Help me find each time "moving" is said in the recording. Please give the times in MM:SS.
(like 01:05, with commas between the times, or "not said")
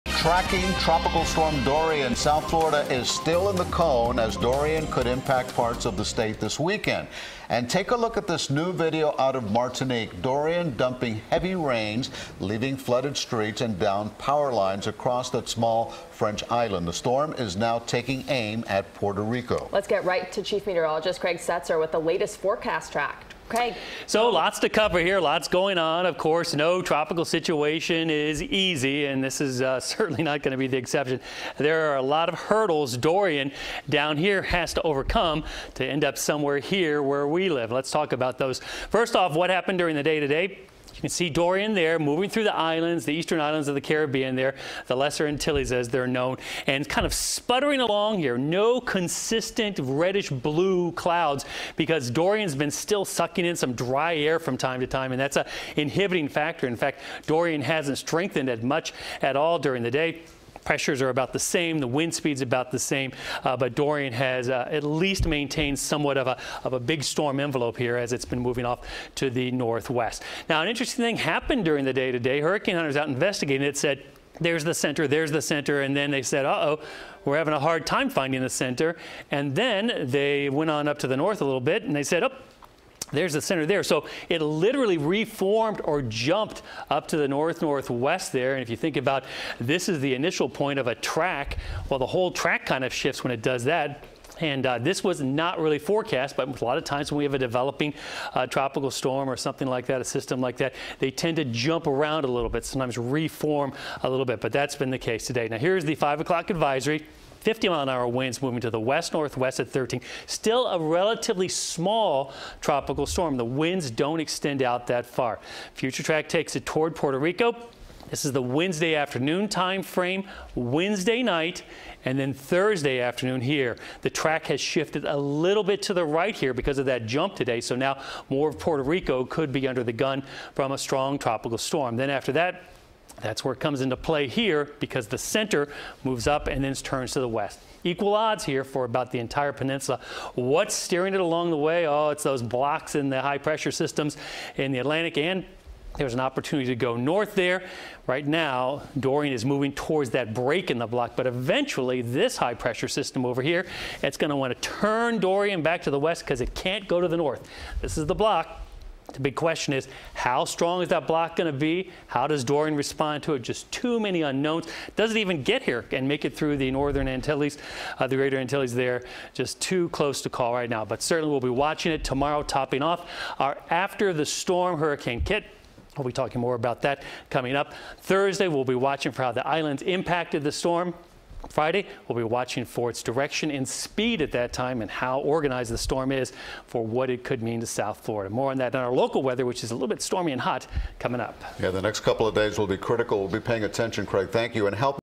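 00:41, 01:08, 01:48, 02:29.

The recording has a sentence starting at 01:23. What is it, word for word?
So it literally reformed or jumped up to the north northwest there.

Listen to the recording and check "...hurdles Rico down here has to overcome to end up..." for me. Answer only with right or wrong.
wrong.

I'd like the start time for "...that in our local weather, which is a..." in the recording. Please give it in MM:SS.
03:08.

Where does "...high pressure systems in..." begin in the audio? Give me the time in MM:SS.
02:23.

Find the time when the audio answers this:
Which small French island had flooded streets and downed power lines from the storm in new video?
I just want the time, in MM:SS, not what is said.
00:09.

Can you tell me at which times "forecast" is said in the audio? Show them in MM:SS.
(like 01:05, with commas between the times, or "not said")
00:22, 01:35.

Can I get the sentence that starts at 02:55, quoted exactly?
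We'll be talking more about that coming up.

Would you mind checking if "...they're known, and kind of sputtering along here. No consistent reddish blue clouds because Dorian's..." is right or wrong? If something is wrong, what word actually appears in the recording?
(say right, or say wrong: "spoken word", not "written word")
right.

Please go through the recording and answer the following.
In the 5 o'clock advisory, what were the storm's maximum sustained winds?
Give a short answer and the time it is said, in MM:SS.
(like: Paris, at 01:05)
50 mph, at 01:47.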